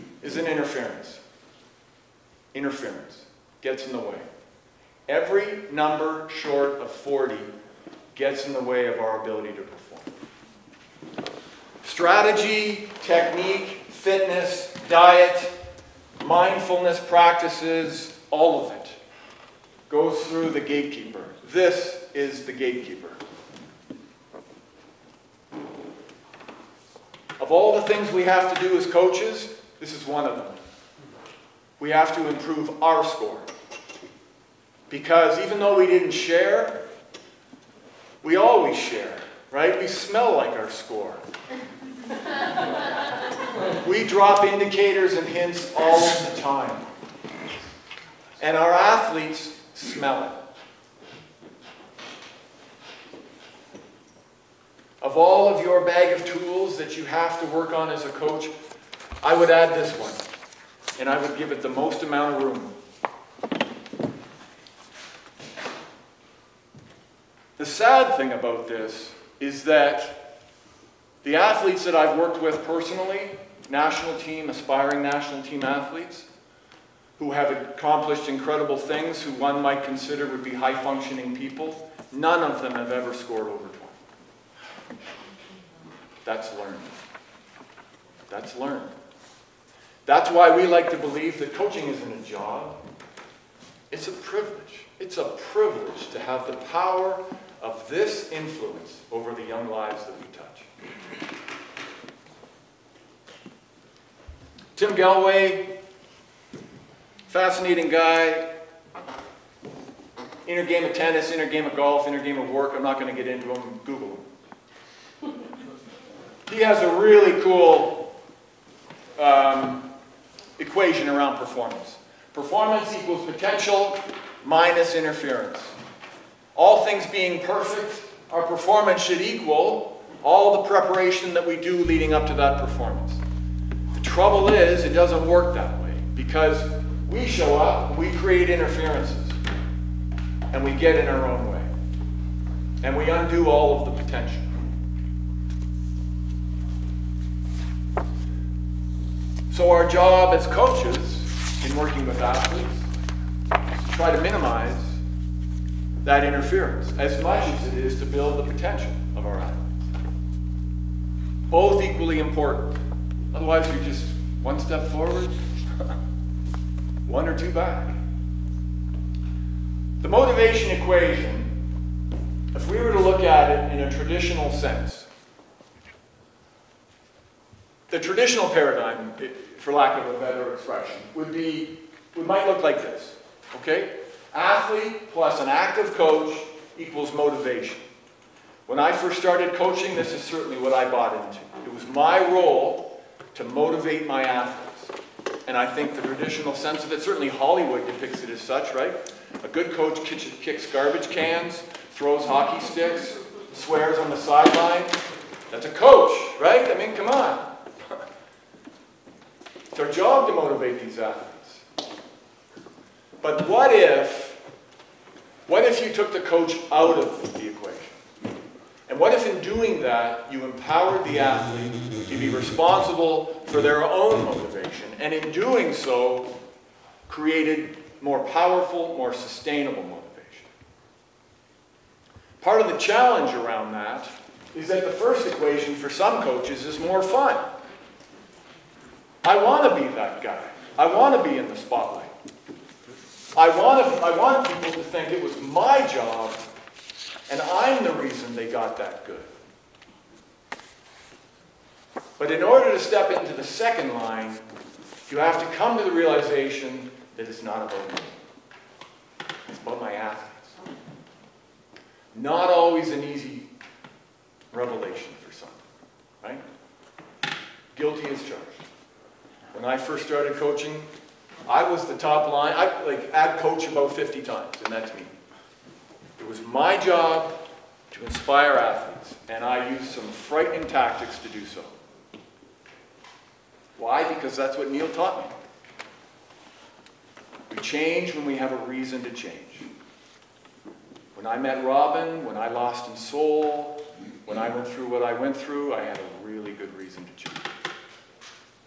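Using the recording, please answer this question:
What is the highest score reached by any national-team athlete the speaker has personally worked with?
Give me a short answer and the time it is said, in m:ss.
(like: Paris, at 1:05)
20, at 1:24.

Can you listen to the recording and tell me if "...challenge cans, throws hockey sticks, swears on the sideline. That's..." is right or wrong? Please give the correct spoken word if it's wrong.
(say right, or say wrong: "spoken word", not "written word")
wrong: "garbage", not "challenge".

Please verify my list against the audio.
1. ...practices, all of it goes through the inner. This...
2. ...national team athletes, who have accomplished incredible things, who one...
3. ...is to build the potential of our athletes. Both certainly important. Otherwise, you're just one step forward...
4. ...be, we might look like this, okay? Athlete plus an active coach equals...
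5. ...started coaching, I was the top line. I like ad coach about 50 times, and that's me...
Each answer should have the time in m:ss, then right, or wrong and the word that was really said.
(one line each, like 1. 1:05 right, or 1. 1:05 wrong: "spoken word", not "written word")
1. 0:17 wrong: "gatekeeper", not "inner"
2. 1:15 right
3. 2:37 wrong: "equally", not "certainly"
4. 3:01 right
5. 4:30 right.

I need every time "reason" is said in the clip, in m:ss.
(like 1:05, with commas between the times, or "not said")
4:07, 4:48, 4:56.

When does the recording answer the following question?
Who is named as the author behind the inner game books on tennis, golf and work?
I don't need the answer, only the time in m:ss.
1:44.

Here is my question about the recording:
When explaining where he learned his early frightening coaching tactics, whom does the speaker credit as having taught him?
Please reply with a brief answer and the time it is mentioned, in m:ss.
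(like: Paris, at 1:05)
Neil, at 4:44.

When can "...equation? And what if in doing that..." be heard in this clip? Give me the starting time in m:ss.
3:37.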